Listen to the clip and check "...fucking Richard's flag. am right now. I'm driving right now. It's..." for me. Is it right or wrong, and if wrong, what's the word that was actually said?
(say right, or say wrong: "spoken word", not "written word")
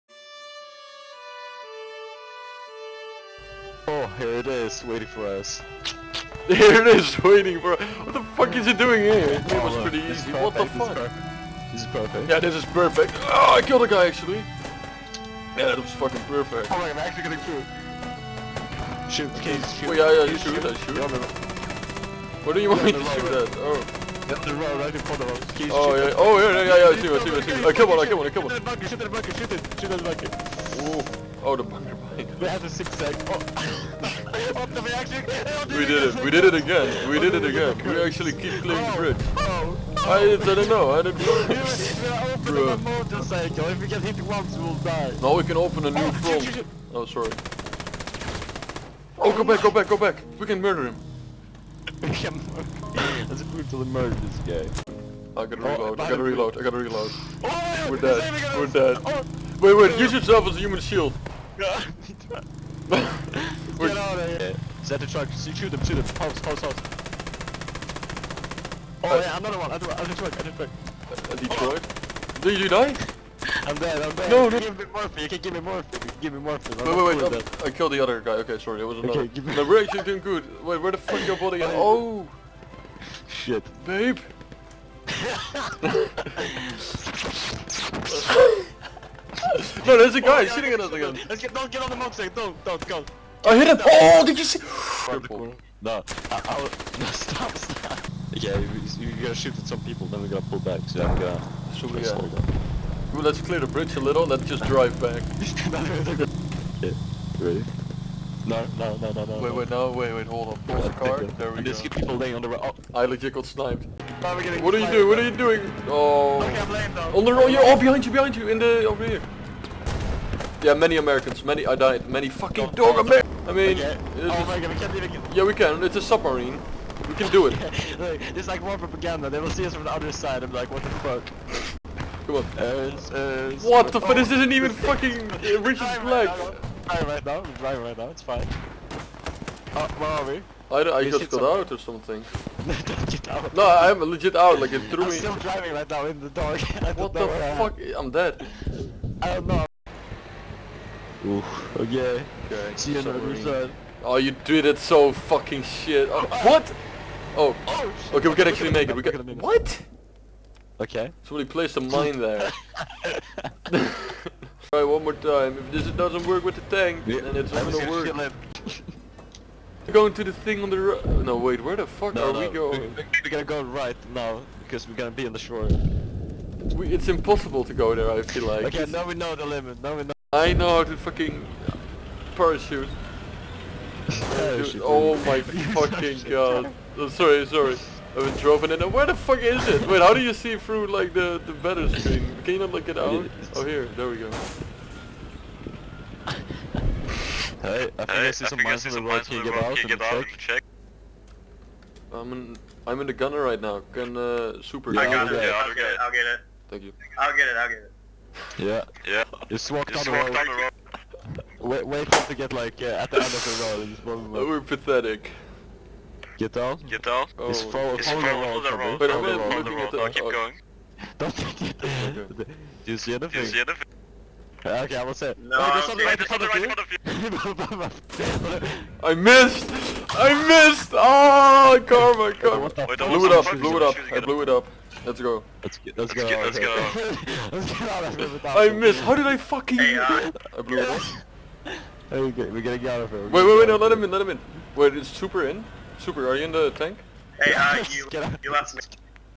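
right.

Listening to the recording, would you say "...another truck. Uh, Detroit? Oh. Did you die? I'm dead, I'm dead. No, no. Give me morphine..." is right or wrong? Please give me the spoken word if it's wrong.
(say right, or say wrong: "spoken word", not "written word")
right.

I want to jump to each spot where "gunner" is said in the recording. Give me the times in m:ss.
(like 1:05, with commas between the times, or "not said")
3:23.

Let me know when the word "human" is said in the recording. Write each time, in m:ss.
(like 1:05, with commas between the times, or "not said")
1:00.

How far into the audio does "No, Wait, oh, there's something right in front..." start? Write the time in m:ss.
3:45.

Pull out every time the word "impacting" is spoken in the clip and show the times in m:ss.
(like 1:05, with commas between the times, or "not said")
not said.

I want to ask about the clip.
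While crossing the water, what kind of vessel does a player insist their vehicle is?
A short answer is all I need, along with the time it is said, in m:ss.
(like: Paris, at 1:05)
Submarine, at 2:05.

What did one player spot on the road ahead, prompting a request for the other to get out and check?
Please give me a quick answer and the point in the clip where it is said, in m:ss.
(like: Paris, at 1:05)
Mines, at 3:18.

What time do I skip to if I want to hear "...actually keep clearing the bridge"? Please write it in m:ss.
0:38.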